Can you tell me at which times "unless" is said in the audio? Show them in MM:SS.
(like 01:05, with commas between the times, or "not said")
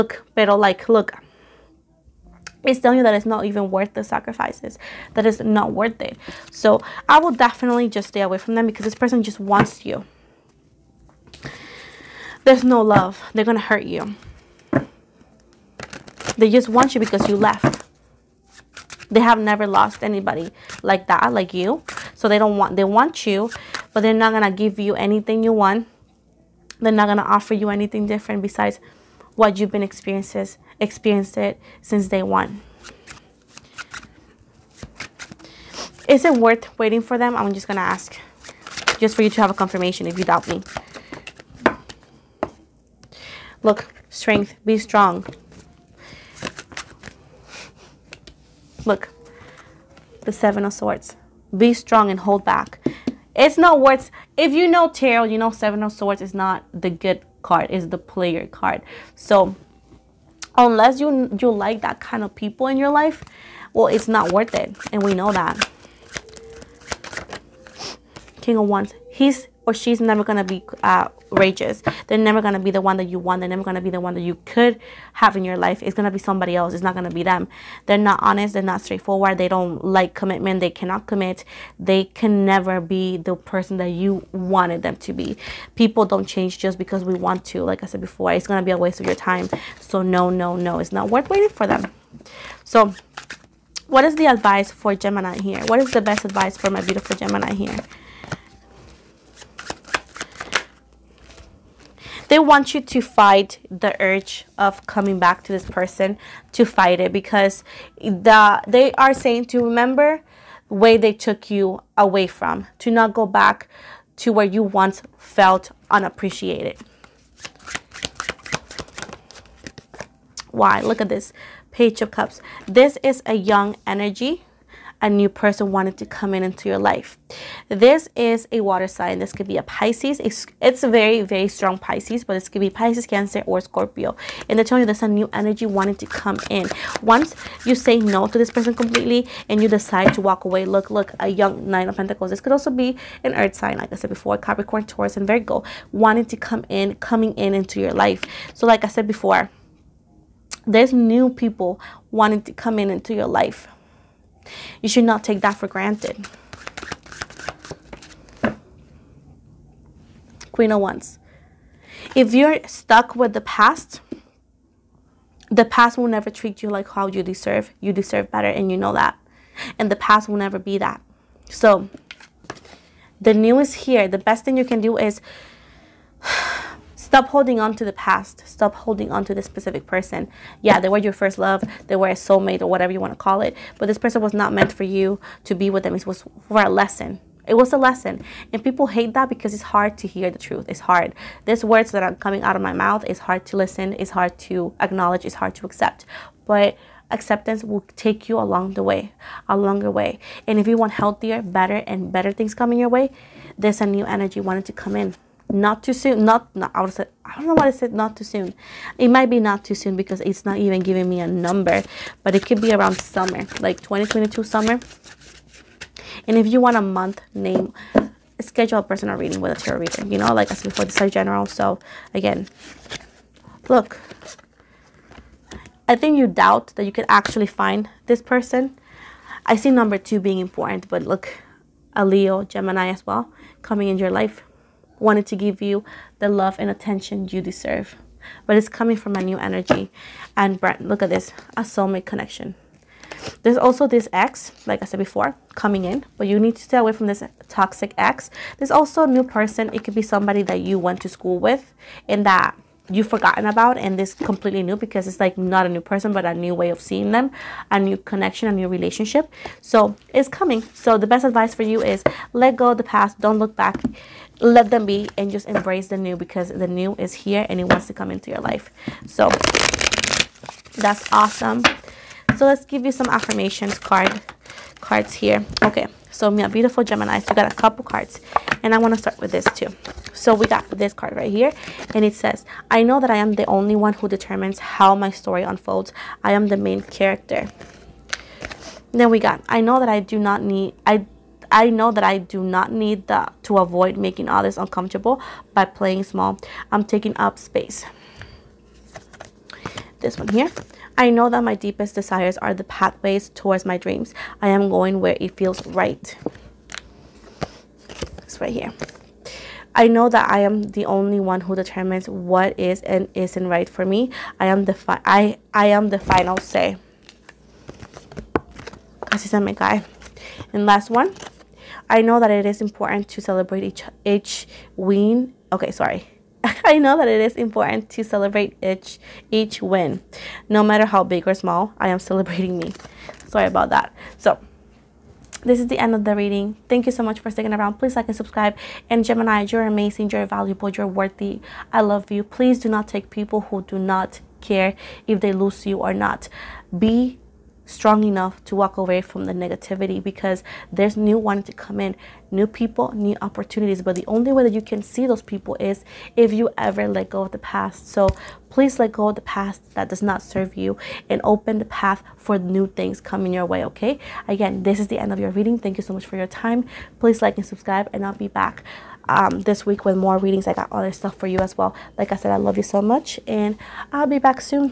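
01:00.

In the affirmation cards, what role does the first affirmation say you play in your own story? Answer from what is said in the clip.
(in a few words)
the main character.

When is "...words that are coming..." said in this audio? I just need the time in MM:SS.
03:11.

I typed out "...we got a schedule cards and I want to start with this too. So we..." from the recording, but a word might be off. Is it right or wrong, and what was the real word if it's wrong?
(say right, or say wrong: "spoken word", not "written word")
wrong: "couple", not "schedule".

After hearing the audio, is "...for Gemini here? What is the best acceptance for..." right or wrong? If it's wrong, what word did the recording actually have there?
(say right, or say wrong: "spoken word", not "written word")
wrong: "advice", not "acceptance".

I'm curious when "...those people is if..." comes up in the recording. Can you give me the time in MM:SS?
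05:55.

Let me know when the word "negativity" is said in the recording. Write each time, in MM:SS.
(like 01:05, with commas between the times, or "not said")
05:49.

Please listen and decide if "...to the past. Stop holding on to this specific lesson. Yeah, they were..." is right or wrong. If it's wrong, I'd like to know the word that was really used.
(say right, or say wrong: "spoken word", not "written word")
wrong: "person", not "lesson".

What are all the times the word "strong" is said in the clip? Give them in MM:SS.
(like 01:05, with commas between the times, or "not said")
00:44, 00:51, 02:11, 05:47.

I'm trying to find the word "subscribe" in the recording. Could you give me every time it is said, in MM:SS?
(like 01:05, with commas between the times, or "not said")
05:38, 06:07.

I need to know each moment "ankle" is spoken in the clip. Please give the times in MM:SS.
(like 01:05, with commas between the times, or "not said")
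not said.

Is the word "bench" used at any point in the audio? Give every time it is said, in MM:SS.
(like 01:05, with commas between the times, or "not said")
not said.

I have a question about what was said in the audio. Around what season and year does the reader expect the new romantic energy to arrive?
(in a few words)
summer 2022.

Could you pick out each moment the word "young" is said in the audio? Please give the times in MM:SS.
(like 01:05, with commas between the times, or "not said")
02:03, 02:21.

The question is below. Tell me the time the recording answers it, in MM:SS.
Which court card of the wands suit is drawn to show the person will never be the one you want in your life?
01:08.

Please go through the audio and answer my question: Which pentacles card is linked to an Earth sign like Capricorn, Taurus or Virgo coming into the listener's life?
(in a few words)
Nine of Pentacles.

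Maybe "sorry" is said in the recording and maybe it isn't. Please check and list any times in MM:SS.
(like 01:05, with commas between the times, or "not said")
05:25, 05:33.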